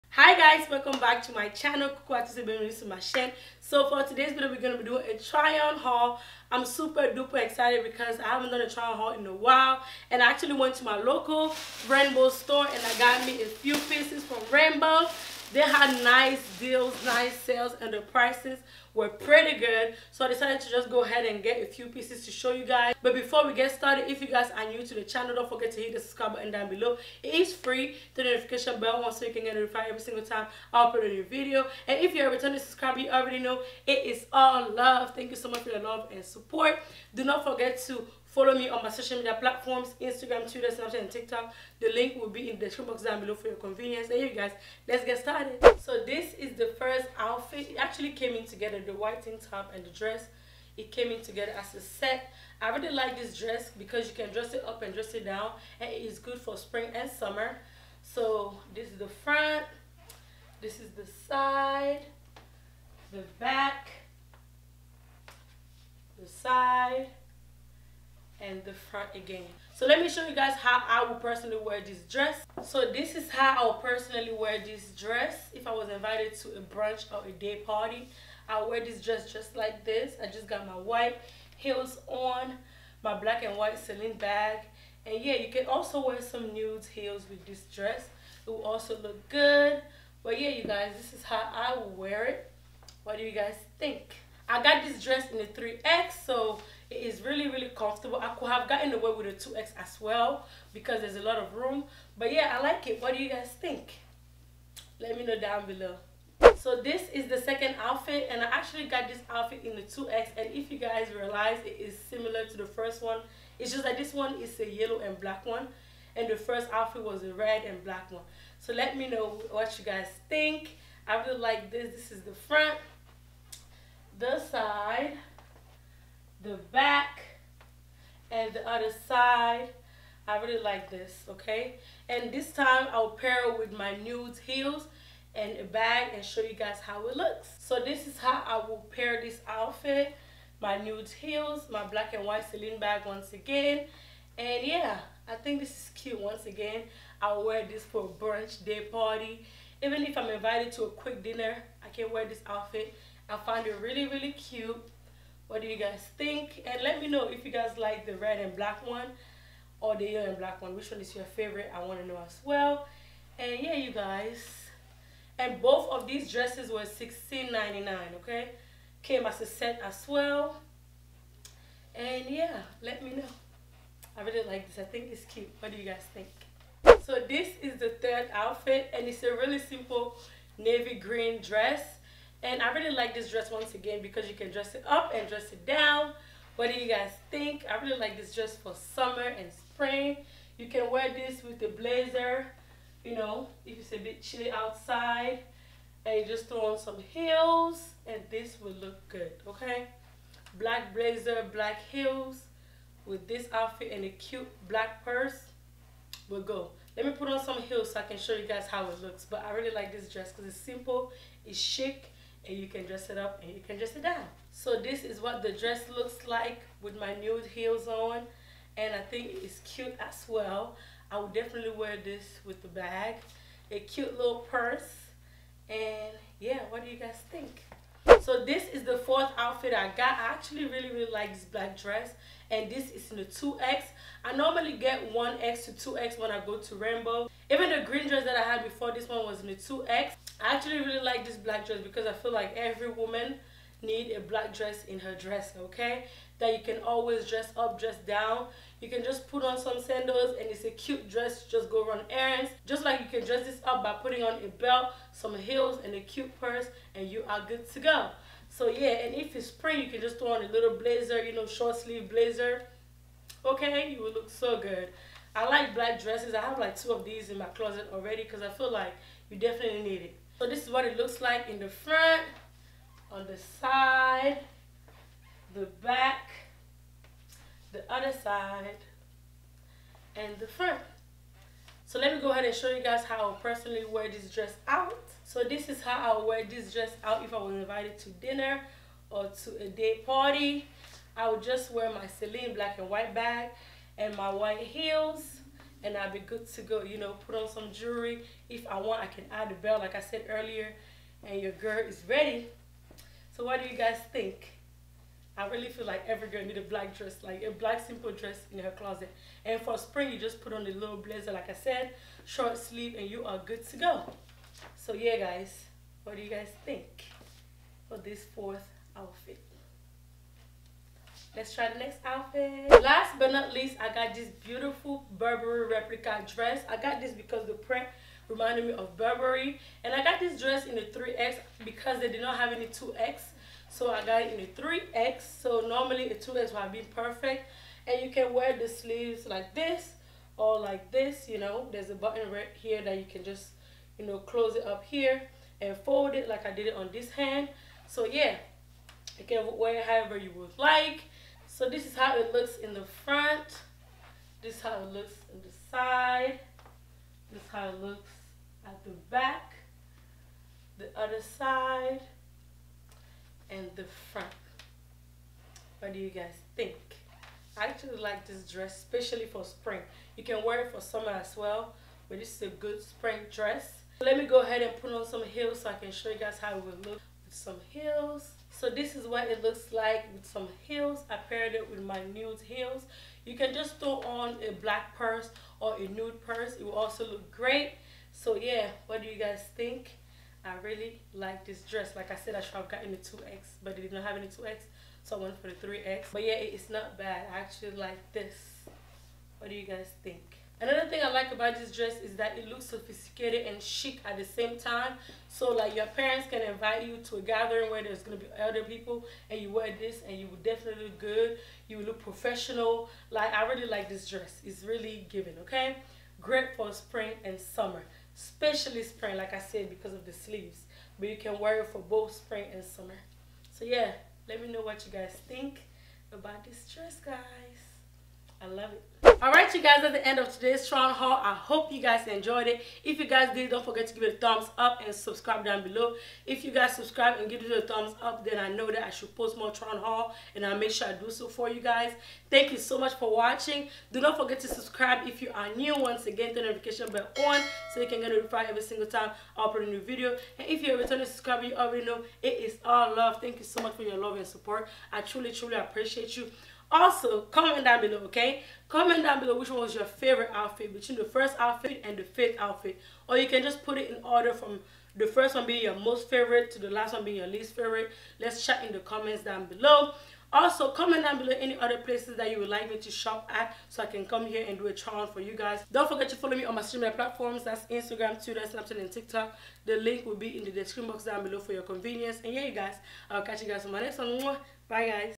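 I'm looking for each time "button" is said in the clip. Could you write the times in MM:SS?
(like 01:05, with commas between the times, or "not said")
00:26, 05:41.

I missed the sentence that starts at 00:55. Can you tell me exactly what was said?
And it is good for spring and summer.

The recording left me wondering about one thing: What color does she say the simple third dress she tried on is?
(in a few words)
navy green.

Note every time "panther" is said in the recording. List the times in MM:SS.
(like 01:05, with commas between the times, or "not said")
not said.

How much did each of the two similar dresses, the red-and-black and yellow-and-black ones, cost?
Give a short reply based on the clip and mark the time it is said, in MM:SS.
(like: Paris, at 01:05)
$16.99, at 02:46.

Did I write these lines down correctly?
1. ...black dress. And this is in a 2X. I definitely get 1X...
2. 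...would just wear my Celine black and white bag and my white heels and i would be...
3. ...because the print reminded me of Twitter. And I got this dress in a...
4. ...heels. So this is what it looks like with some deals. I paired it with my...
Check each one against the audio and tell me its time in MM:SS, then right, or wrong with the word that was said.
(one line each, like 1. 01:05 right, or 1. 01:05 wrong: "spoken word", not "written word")
1. 03:51 wrong: "normally", not "definitely"
2. 04:51 right
3. 05:27 wrong: "Burberry", not "Twitter"
4. 06:17 wrong: "heels", not "deals".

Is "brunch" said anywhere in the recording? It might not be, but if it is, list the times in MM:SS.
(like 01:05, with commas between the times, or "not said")
01:16, 02:28.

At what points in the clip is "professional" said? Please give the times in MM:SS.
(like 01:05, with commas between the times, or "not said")
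06:52.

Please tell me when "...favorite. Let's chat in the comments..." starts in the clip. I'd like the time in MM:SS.
07:47.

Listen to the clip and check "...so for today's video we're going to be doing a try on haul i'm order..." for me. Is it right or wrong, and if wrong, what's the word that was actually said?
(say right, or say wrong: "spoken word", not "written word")
wrong: "super", not "order".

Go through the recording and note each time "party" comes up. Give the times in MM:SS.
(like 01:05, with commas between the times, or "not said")
01:17, 02:28, 04:50.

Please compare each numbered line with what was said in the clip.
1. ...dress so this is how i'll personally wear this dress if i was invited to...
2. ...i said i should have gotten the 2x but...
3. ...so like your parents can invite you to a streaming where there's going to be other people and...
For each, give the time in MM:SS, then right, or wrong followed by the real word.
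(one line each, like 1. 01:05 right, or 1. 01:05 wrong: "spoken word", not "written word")
1. 01:12 right
2. 06:32 right
3. 06:45 wrong: "gathering", not "streaming".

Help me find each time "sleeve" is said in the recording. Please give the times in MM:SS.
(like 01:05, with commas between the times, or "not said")
04:21, 05:12, 05:38, 07:00.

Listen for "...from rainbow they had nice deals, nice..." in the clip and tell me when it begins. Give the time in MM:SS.
00:14.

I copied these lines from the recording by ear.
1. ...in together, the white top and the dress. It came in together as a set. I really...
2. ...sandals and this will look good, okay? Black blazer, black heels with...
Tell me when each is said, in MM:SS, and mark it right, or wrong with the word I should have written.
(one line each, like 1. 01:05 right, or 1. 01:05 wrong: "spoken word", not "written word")
1. 00:48 right
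2. 03:16 wrong: "heels", not "sandals".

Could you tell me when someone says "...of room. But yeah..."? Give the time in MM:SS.
01:41.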